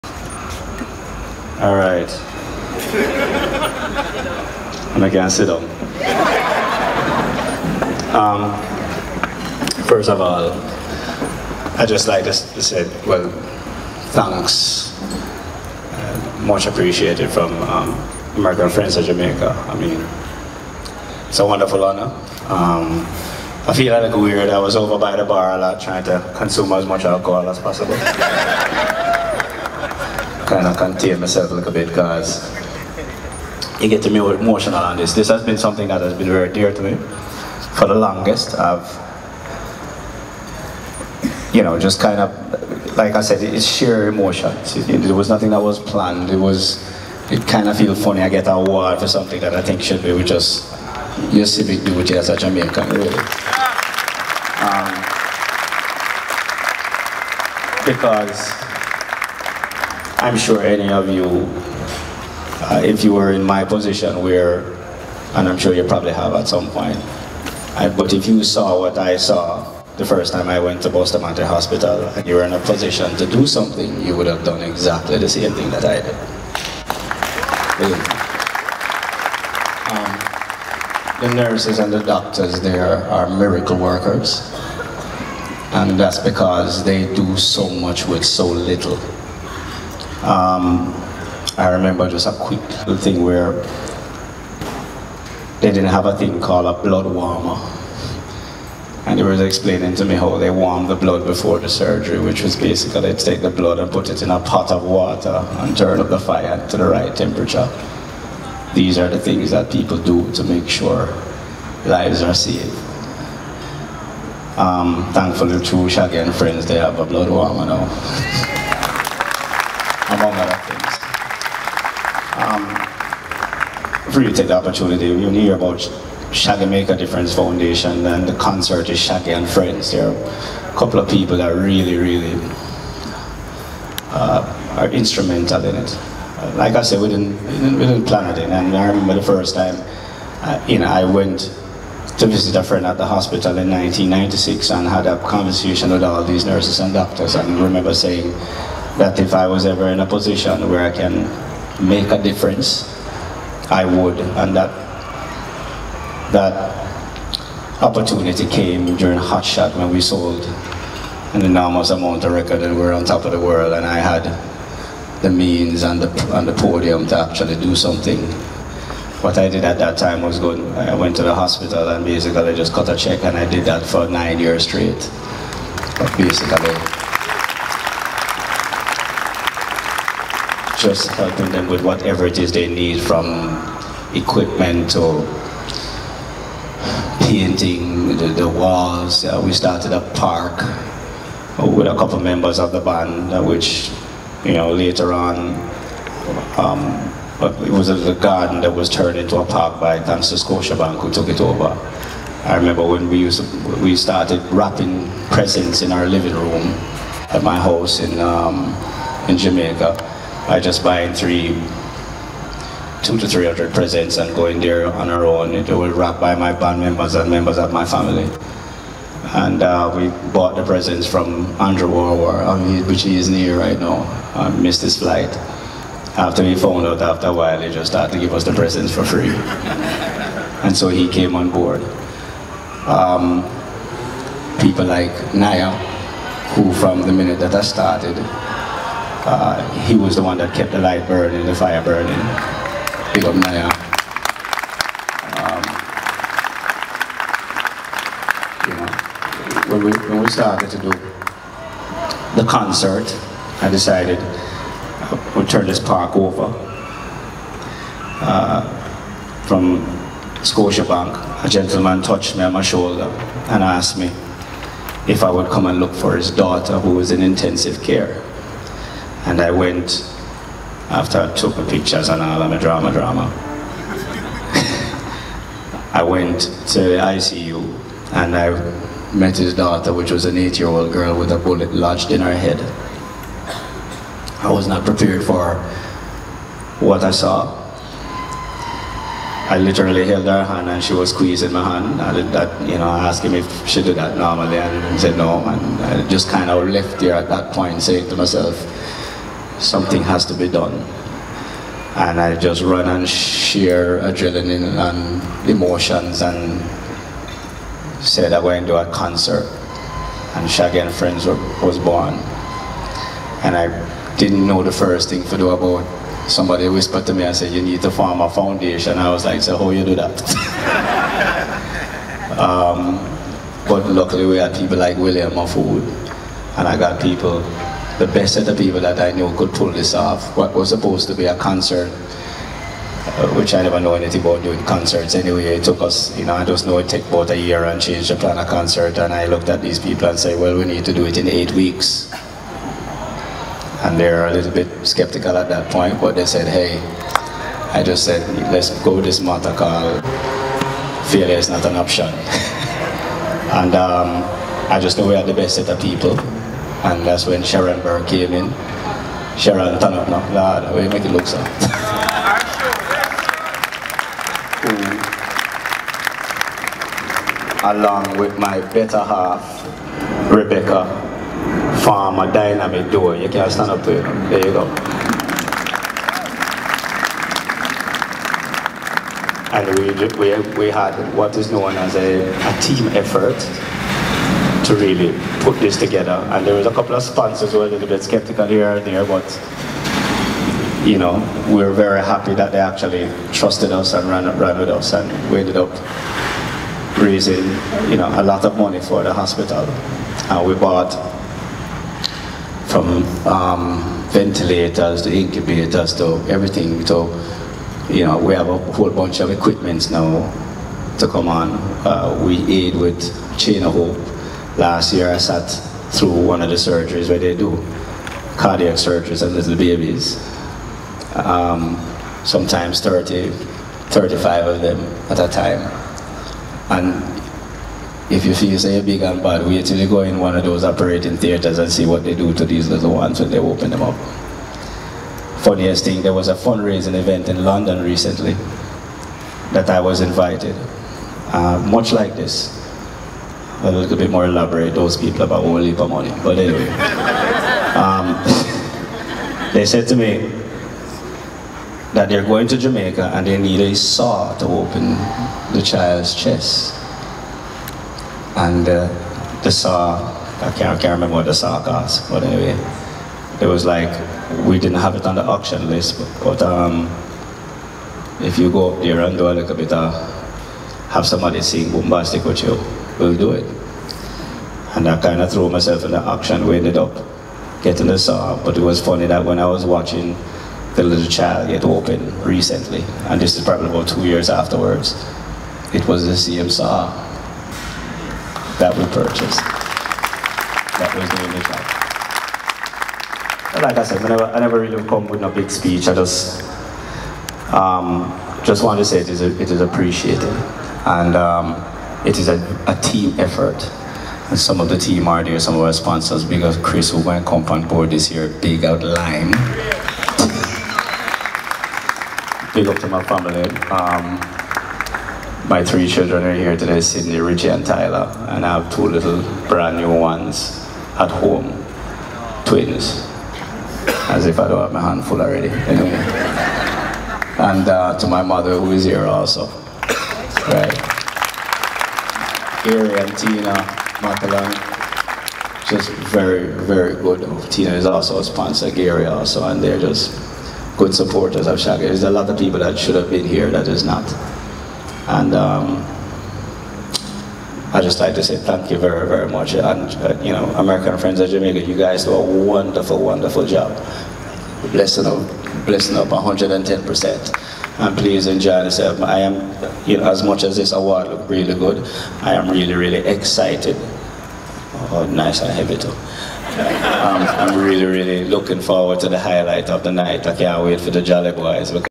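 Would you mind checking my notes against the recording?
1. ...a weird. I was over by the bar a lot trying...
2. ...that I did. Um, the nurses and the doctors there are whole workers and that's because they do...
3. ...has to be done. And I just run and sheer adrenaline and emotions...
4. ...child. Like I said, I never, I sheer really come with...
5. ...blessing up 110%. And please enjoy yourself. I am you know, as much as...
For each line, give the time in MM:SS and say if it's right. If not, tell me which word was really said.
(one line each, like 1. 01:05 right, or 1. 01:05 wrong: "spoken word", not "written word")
1. 00:24 right
2. 01:15 wrong: "miracle", not "whole"
3. 05:00 right
4. 08:11 wrong: "never", not "sheer"
5. 09:15 right.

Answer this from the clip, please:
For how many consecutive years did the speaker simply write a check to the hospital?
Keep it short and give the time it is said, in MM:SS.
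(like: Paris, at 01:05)
9, at 02:54.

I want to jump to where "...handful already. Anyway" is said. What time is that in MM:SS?
08:44.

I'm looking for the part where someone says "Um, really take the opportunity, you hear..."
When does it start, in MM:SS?
02:02.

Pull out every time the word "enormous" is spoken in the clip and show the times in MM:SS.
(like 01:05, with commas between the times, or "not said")
02:41.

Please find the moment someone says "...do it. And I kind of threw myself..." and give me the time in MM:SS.
07:53.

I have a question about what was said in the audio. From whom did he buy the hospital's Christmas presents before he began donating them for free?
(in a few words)
Andrew Warwar.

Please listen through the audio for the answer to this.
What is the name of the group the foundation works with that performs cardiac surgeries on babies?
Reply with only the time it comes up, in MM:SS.
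06:53.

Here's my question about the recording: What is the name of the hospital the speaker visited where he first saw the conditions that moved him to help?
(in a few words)
Bustamante Hospital.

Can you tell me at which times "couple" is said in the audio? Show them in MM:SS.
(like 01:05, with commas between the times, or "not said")
02:10, 03:11, 06:26.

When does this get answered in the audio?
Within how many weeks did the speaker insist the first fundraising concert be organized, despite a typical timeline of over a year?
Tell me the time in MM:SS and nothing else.
05:41.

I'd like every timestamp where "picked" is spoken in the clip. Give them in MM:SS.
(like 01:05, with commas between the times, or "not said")
not said.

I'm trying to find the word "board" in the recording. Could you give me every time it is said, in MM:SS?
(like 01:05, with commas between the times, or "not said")
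03:51, 08:27.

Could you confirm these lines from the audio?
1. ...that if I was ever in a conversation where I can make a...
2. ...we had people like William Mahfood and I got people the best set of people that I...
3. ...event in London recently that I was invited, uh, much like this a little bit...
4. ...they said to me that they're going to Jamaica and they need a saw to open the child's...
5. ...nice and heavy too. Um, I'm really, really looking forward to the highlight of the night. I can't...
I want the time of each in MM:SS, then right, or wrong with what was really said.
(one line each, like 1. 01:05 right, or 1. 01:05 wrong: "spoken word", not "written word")
1. 02:28 wrong: "position", not "conversation"
2. 05:24 right
3. 07:16 right
4. 07:29 right
5. 09:25 right.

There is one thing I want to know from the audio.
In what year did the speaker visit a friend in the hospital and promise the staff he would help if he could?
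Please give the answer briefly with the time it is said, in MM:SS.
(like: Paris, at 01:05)
1996, at 02:23.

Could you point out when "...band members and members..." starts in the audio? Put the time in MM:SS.
03:36.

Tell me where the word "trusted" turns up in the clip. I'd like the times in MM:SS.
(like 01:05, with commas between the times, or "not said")
06:33.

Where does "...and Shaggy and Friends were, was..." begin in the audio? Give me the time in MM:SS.
05:10.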